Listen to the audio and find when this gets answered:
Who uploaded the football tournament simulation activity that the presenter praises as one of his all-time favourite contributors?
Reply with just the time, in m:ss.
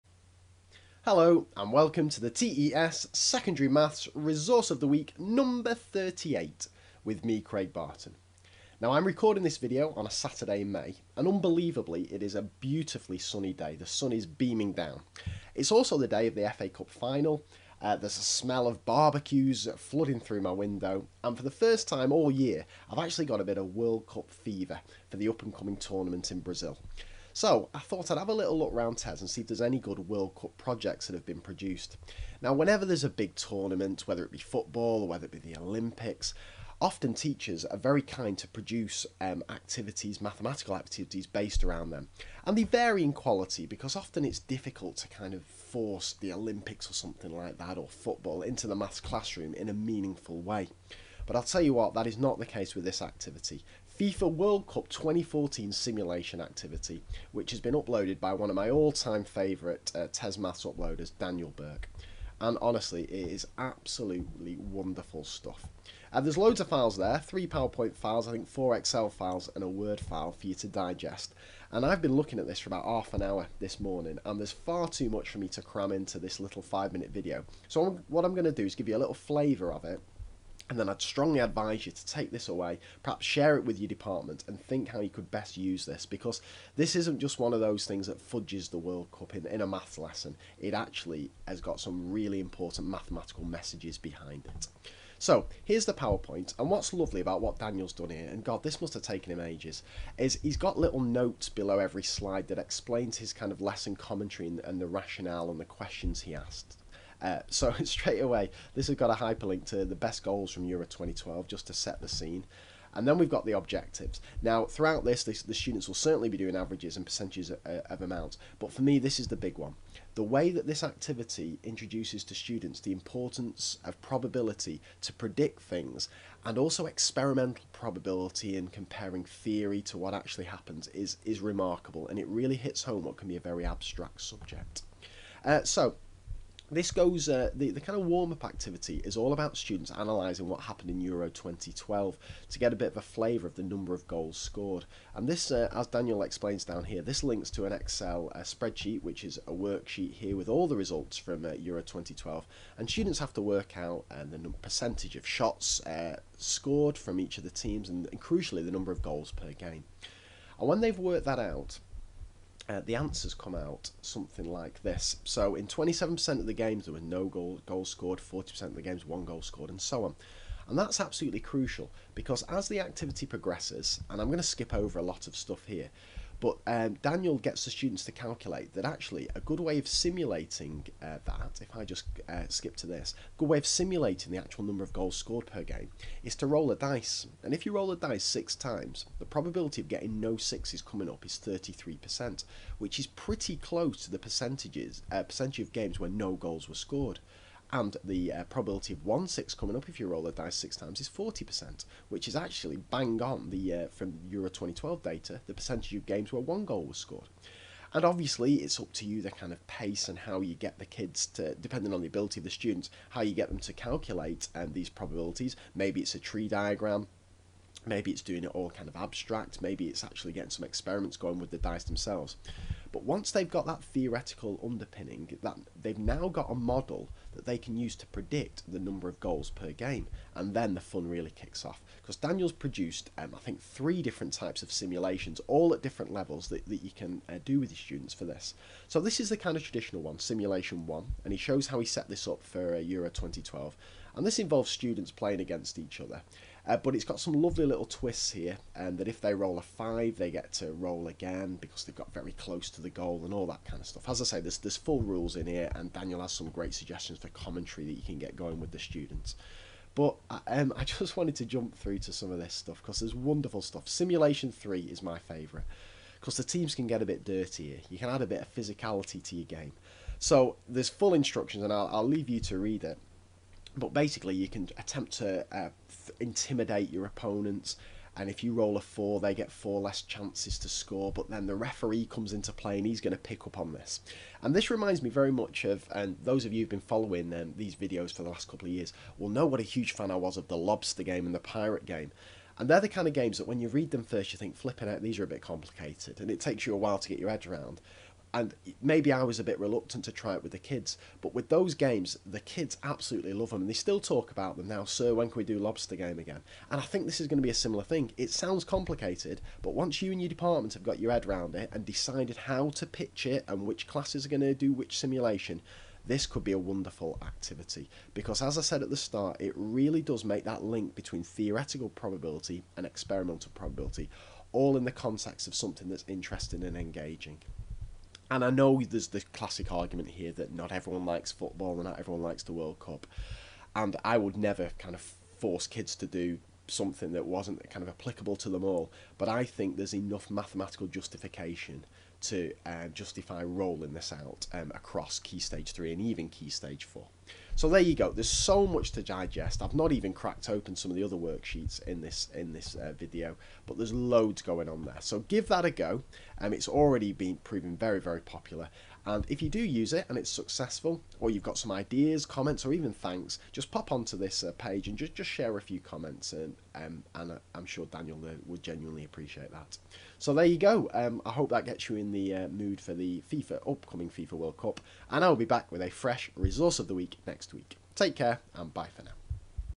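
1:01.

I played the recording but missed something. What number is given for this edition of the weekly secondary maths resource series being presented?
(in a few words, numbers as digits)
38.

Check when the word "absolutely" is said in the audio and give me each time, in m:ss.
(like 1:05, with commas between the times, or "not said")
1:03, 2:51, 5:02.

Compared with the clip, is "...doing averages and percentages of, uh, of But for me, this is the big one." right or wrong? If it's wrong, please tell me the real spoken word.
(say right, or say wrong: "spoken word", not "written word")
right.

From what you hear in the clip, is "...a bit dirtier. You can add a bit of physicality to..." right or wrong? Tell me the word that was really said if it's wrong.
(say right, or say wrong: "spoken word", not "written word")
right.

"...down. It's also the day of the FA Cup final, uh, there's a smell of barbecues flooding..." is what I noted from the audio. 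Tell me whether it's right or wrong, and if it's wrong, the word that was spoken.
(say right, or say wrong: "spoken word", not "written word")
right.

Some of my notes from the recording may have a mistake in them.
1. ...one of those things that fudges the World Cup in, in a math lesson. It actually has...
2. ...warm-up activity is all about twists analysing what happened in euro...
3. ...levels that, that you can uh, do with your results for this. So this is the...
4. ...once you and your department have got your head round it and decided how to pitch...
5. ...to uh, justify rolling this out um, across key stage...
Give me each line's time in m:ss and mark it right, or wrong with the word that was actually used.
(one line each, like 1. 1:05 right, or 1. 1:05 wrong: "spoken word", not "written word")
1. 1:27 right
2. 2:18 wrong: "students", not "twists"
3. 3:56 wrong: "students", not "results"
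4. 5:09 right
5. 5:42 right.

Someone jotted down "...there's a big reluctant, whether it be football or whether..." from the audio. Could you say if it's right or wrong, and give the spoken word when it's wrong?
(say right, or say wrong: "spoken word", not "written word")
wrong: "tournament", not "reluctant".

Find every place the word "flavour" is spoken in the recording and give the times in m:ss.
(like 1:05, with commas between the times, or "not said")
1:19, 2:23.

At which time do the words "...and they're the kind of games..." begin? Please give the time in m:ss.
4:52.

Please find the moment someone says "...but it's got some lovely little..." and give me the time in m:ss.
4:06.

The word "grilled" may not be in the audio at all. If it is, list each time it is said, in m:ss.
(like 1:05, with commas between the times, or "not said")
not said.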